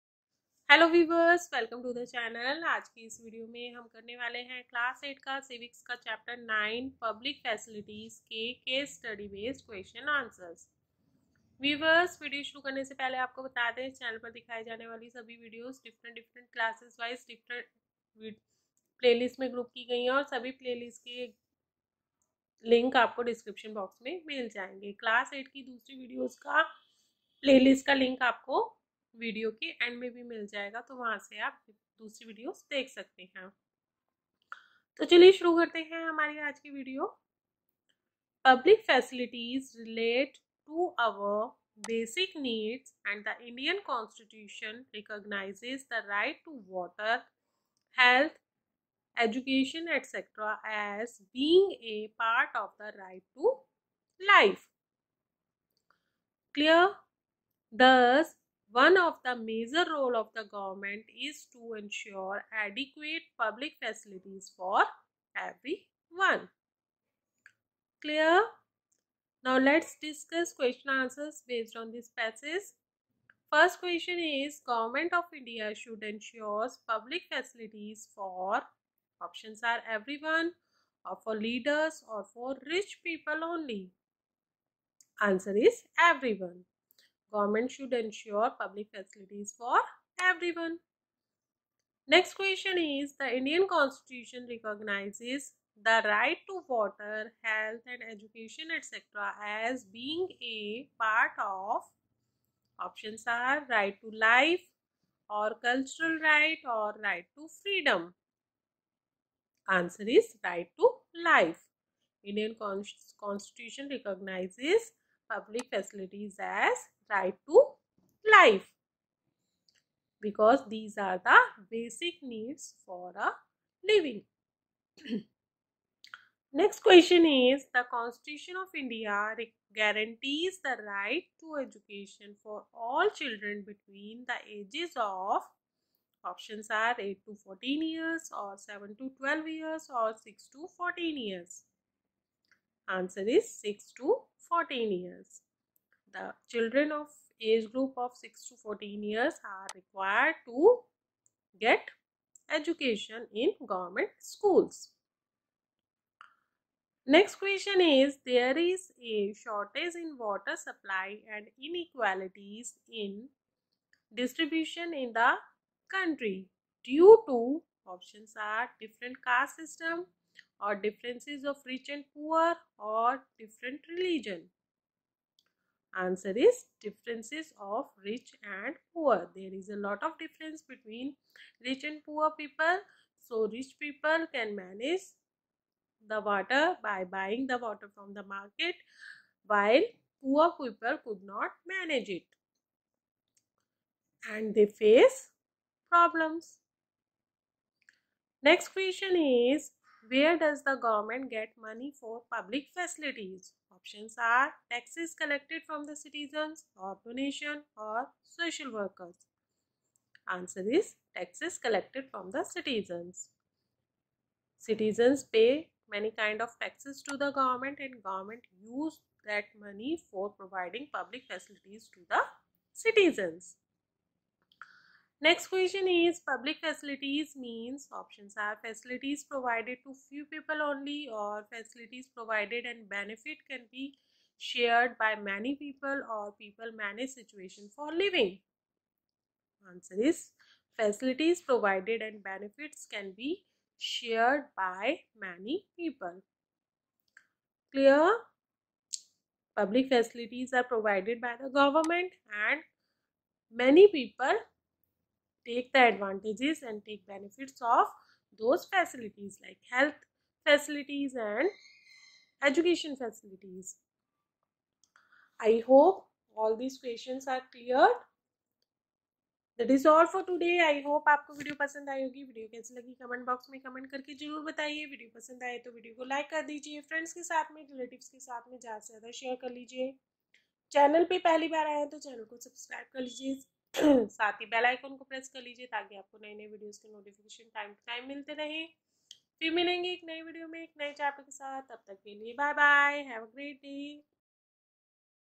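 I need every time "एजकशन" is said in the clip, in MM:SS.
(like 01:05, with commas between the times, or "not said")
00:49.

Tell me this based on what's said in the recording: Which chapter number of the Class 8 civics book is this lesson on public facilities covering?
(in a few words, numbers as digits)
9.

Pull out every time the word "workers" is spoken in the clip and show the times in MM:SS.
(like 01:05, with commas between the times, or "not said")
03:28.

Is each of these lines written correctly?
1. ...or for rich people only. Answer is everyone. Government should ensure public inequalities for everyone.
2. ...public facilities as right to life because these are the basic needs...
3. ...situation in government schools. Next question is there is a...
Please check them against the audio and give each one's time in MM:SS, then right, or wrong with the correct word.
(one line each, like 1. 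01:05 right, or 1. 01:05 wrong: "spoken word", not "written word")
1. 01:22 wrong: "facilities", not "inequalities"
2. 01:55 right
3. 02:32 wrong: "education", not "situation".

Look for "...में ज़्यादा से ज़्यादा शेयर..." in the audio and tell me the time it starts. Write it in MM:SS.
04:38.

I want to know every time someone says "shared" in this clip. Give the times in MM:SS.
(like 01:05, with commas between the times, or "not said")
03:54, 04:03.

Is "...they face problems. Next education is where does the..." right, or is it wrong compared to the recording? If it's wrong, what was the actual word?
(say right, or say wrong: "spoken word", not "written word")
wrong: "question", not "education".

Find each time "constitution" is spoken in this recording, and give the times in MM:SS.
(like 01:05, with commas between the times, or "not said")
01:33, 01:52, 02:07.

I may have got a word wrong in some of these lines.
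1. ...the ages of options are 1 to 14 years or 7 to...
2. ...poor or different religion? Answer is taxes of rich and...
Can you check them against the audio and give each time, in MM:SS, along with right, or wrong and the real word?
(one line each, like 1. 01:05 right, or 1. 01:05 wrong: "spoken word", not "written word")
1. 02:14 wrong: "8", not "1"
2. 02:52 wrong: "differences", not "taxes".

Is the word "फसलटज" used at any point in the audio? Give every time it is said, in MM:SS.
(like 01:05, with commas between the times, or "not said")
00:07, 00:38.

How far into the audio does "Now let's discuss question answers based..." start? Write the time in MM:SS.
01:09.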